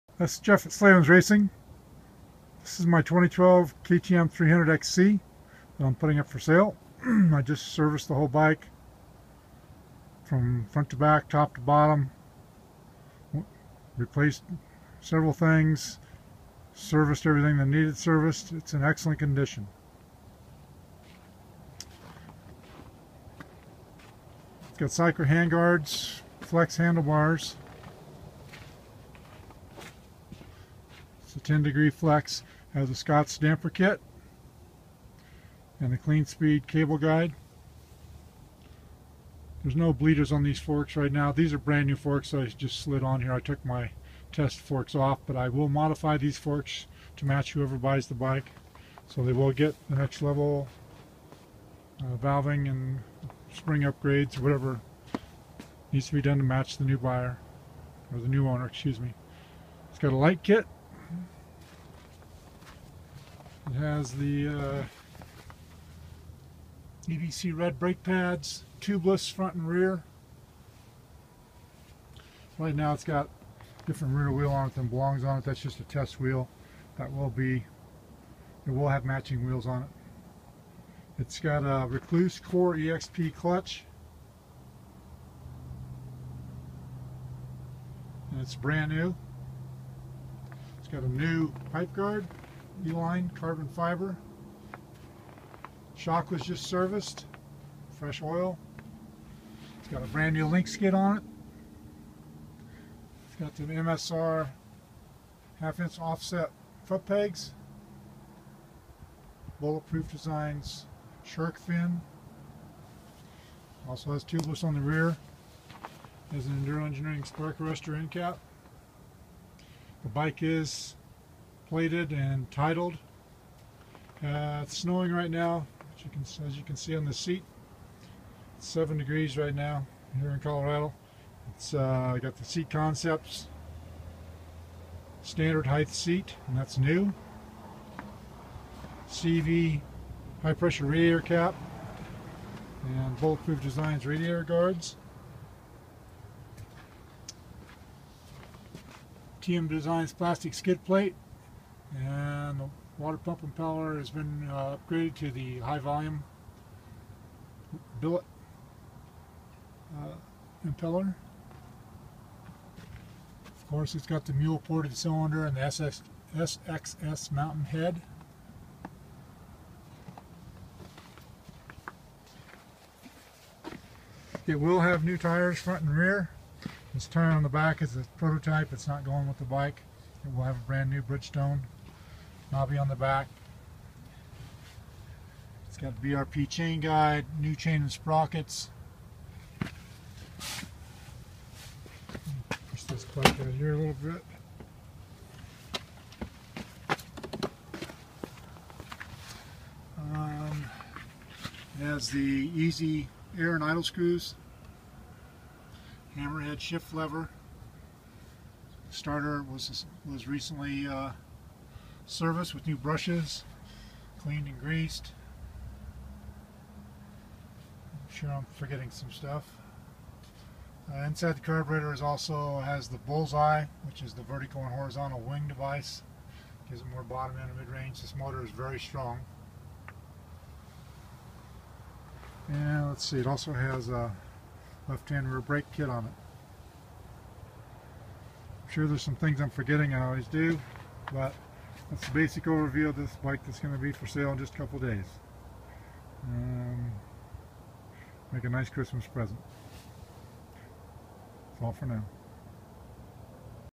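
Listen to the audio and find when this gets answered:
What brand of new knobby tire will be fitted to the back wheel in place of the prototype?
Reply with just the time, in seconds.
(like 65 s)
181 s.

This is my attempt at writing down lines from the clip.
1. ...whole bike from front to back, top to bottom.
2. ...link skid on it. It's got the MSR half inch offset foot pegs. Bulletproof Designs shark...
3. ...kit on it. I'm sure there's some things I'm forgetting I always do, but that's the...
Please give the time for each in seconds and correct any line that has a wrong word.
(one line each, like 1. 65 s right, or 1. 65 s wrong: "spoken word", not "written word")
1. 8 s right
2. 100 s right
3. 235 s right.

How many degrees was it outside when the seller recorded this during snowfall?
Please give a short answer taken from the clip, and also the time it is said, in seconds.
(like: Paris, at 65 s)
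7, at 128 s.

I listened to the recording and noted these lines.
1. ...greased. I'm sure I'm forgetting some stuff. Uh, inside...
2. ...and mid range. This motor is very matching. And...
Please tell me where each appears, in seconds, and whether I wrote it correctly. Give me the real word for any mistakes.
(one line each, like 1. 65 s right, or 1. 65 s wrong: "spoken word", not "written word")
1. 214 s right
2. 227 s wrong: "strong", not "matching".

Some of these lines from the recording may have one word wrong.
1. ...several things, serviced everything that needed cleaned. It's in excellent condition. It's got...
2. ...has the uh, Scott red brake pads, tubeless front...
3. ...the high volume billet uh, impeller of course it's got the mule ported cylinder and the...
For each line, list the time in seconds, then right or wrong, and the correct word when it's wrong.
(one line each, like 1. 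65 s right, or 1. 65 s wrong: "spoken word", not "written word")
1. 14 s wrong: "serviced", not "cleaned"
2. 63 s wrong: "EBC", not "Scott"
3. 155 s right.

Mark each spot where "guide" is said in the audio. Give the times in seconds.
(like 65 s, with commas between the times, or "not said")
36 s, 186 s.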